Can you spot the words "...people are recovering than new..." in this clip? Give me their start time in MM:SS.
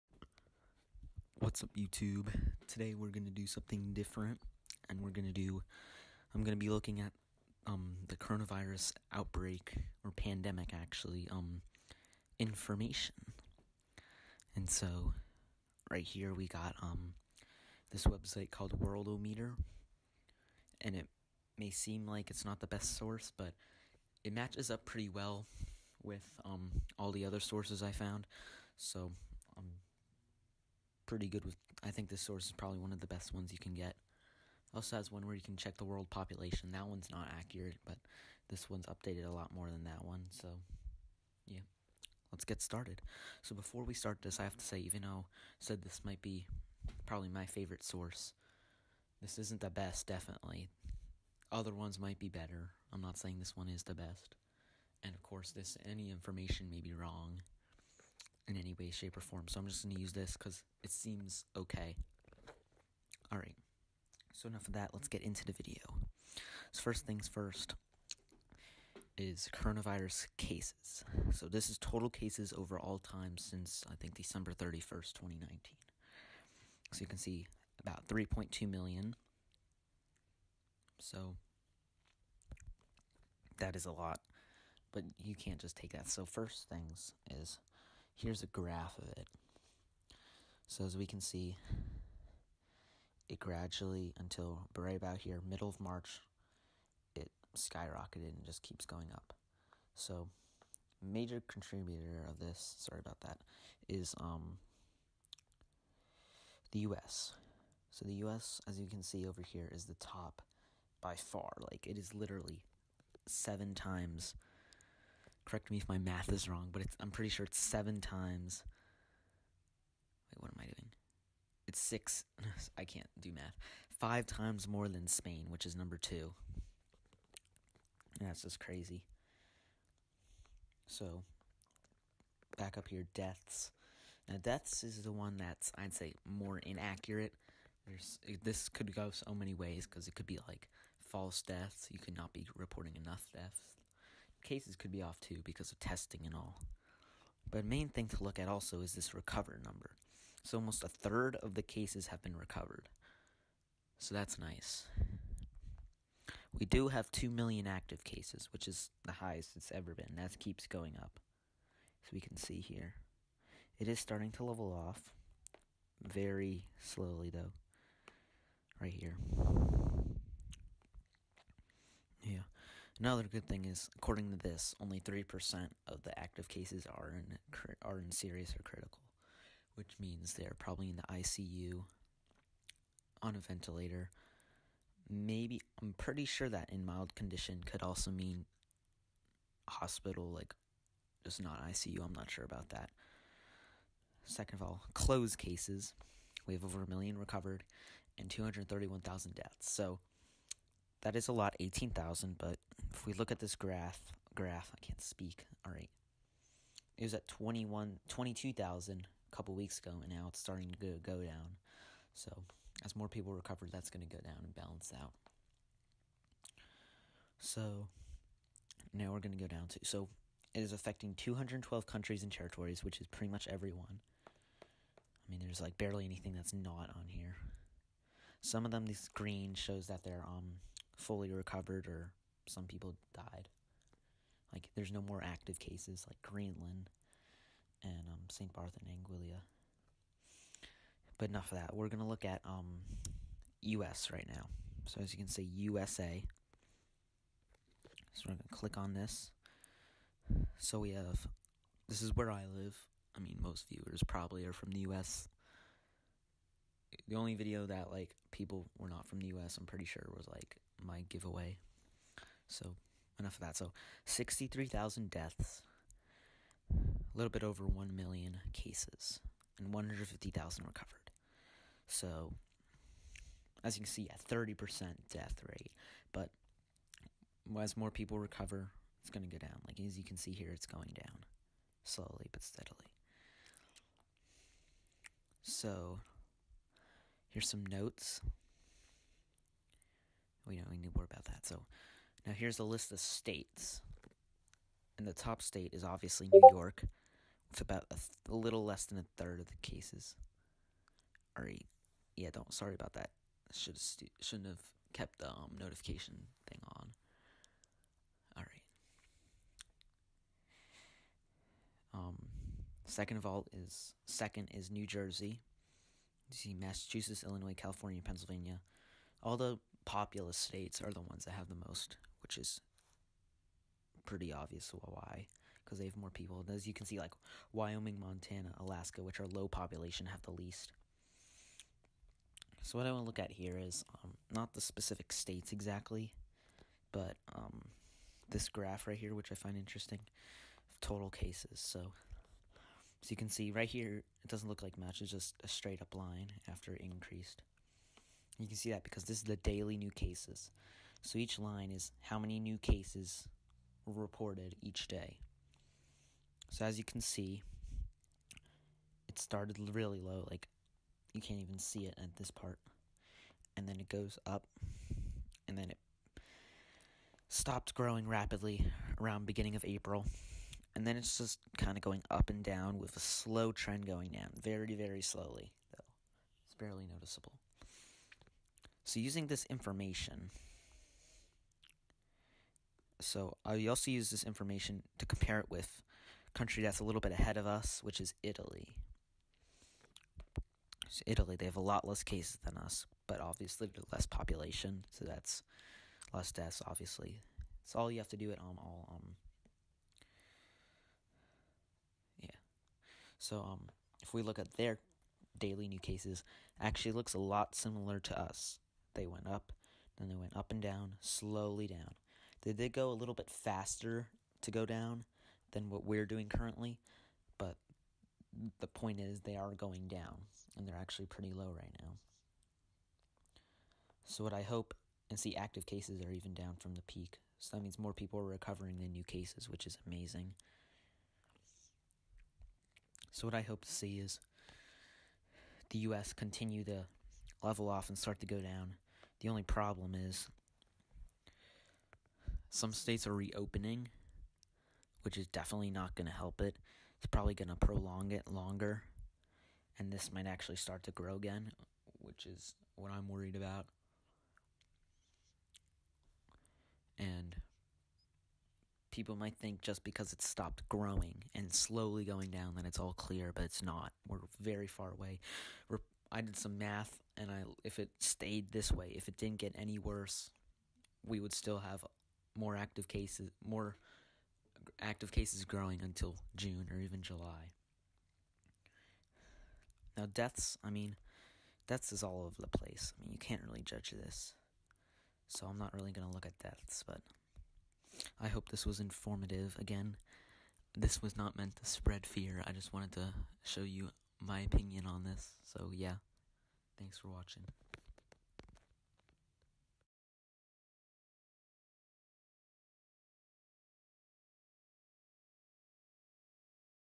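07:07.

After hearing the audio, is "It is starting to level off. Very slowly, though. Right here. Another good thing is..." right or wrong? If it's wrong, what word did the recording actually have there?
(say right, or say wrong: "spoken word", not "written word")
right.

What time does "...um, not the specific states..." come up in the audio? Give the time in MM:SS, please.
05:34.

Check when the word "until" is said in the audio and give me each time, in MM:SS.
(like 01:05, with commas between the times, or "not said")
01:34, 07:55.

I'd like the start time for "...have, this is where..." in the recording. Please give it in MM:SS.
04:10.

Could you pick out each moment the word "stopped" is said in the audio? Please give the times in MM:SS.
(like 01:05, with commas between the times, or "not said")
06:07, 07:40.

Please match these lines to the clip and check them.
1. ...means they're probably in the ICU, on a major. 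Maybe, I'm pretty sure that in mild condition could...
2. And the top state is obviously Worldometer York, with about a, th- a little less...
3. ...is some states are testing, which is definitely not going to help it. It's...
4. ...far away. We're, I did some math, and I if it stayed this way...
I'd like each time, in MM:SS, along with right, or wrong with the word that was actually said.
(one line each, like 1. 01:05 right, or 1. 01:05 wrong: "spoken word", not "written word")
1. 02:59 wrong: "ventilator", not "major"
2. 04:54 wrong: "New", not "Worldometer"
3. 07:19 wrong: "reopening", not "testing"
4. 07:44 right.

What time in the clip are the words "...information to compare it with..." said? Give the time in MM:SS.
06:24.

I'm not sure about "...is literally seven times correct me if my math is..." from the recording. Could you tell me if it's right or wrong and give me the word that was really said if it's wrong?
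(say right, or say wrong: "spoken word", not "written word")
right.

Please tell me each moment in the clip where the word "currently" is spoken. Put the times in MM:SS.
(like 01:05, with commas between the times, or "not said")
06:56.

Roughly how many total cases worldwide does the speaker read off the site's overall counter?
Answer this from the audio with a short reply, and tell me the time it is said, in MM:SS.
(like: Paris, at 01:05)
3.2 million, at 01:18.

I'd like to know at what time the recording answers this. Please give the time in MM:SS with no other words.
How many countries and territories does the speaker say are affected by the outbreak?
03:41.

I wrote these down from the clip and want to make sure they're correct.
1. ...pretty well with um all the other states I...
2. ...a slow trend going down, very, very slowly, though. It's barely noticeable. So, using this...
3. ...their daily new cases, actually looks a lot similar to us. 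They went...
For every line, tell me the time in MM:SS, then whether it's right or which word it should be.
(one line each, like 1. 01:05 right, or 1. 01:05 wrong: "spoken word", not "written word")
1. 00:24 wrong: "sources", not "states"
2. 06:12 right
3. 06:44 right.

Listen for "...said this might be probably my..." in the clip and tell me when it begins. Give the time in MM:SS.
00:45.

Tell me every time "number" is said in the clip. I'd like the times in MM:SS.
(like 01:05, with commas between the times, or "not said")
02:05, 02:29.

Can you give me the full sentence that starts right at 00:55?
And of course, this any information may be wrong in any way, shape, or form.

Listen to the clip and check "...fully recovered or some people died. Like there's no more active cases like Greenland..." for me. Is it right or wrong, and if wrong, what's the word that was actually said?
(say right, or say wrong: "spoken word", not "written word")
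right.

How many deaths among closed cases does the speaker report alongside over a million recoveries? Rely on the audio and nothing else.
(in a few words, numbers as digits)
231,000.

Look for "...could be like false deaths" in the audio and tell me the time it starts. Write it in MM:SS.
02:20.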